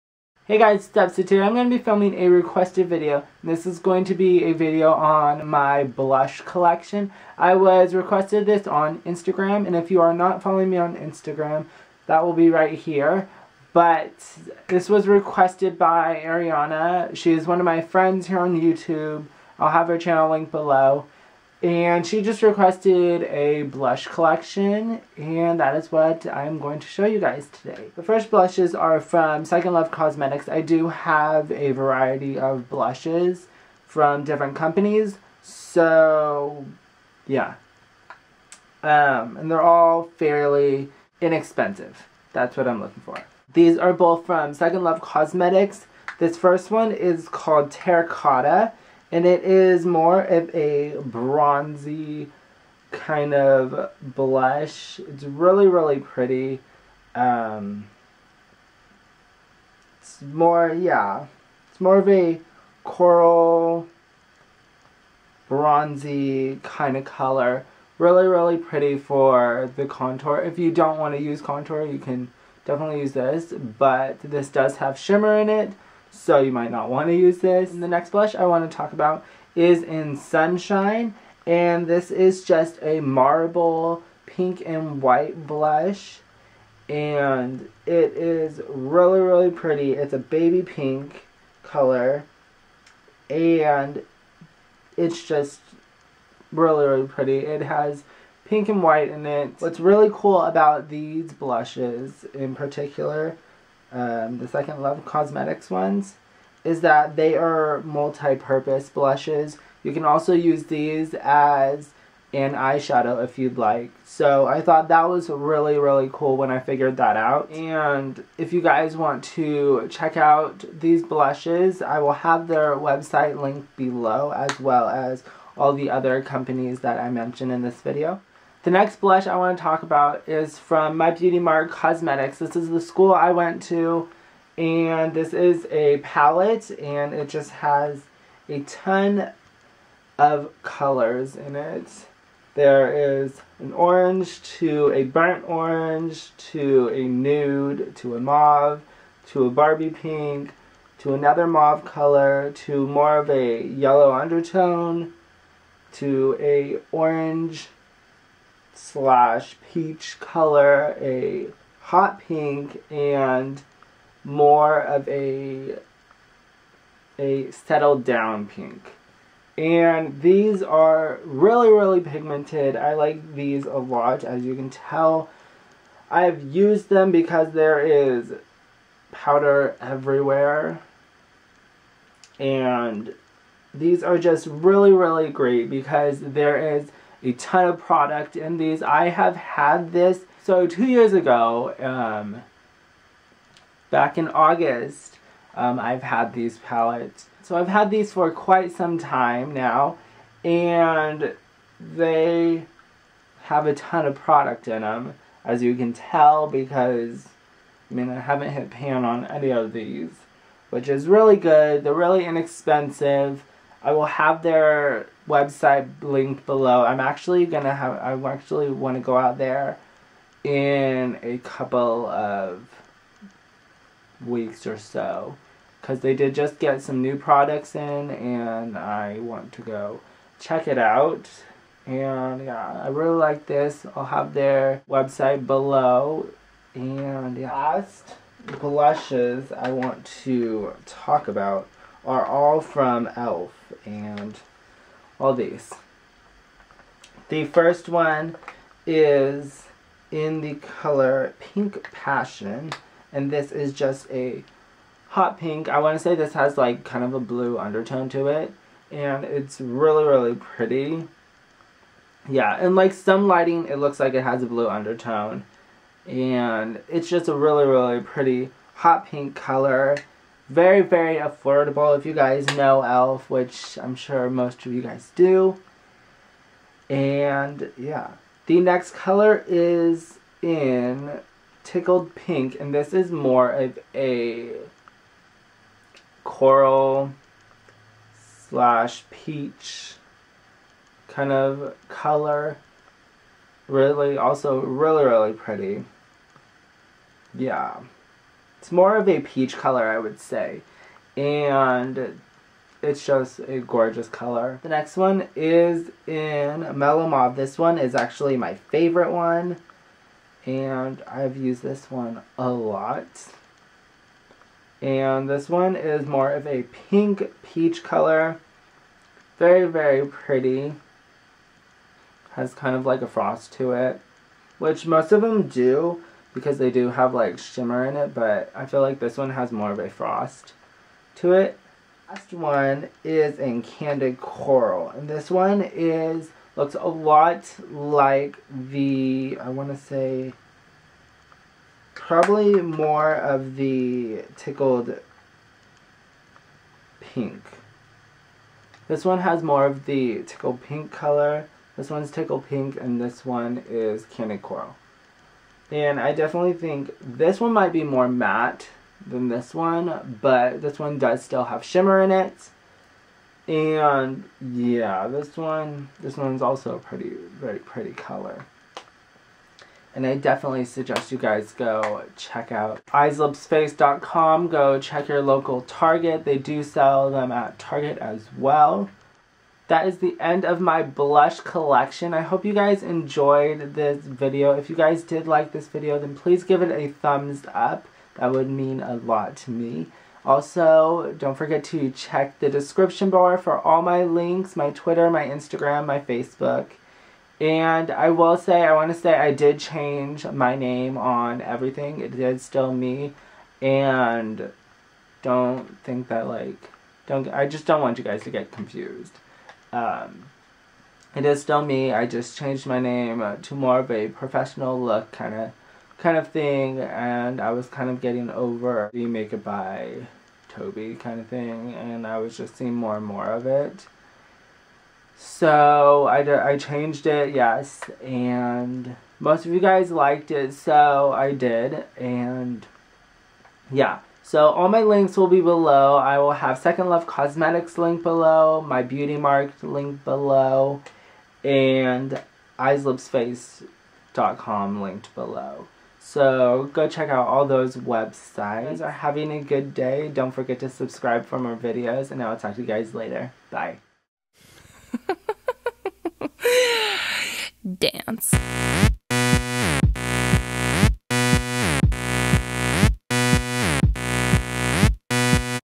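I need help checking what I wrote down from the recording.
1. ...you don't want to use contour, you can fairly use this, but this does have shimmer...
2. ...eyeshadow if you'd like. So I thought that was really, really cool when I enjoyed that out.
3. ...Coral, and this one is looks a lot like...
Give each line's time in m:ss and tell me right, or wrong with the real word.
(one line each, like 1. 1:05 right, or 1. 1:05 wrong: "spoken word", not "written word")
1. 1:10 wrong: "definitely", not "fairly"
2. 1:52 wrong: "figured", not "enjoyed"
3. 5:34 right.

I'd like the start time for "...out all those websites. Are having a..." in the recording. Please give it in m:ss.
7:27.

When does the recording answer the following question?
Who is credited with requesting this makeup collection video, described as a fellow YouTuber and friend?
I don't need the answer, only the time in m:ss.
0:16.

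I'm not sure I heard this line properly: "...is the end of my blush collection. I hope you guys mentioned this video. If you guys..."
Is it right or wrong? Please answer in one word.
wrong.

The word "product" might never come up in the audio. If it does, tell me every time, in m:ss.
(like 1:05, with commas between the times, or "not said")
3:07, 3:24, 3:47.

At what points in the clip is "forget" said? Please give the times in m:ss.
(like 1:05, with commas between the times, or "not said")
6:31, 7:30.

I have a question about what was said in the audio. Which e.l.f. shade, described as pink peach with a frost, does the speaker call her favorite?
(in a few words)
Mellow Mauve.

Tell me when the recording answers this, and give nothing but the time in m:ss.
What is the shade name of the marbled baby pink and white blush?
1:20.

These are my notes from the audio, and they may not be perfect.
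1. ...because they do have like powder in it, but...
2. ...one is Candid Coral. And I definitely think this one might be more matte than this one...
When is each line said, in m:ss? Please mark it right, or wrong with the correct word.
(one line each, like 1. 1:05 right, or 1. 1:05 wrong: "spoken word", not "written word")
1. 5:26 wrong: "shimmer", not "powder"
2. 5:53 right.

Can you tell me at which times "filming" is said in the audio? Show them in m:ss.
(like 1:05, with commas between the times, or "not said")
0:01.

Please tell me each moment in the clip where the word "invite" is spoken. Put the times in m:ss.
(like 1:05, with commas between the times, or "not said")
not said.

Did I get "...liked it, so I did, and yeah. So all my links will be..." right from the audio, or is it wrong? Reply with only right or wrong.
right.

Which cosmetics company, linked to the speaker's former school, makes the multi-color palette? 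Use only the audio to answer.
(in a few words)
My Beauty Mark Cosmetics.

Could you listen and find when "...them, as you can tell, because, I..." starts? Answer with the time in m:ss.
3:24.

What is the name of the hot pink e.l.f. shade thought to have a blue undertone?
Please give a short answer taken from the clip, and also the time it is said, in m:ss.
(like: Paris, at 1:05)
Pink Passion, at 4:11.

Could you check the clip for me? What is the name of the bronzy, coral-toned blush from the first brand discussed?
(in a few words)
Terracotta.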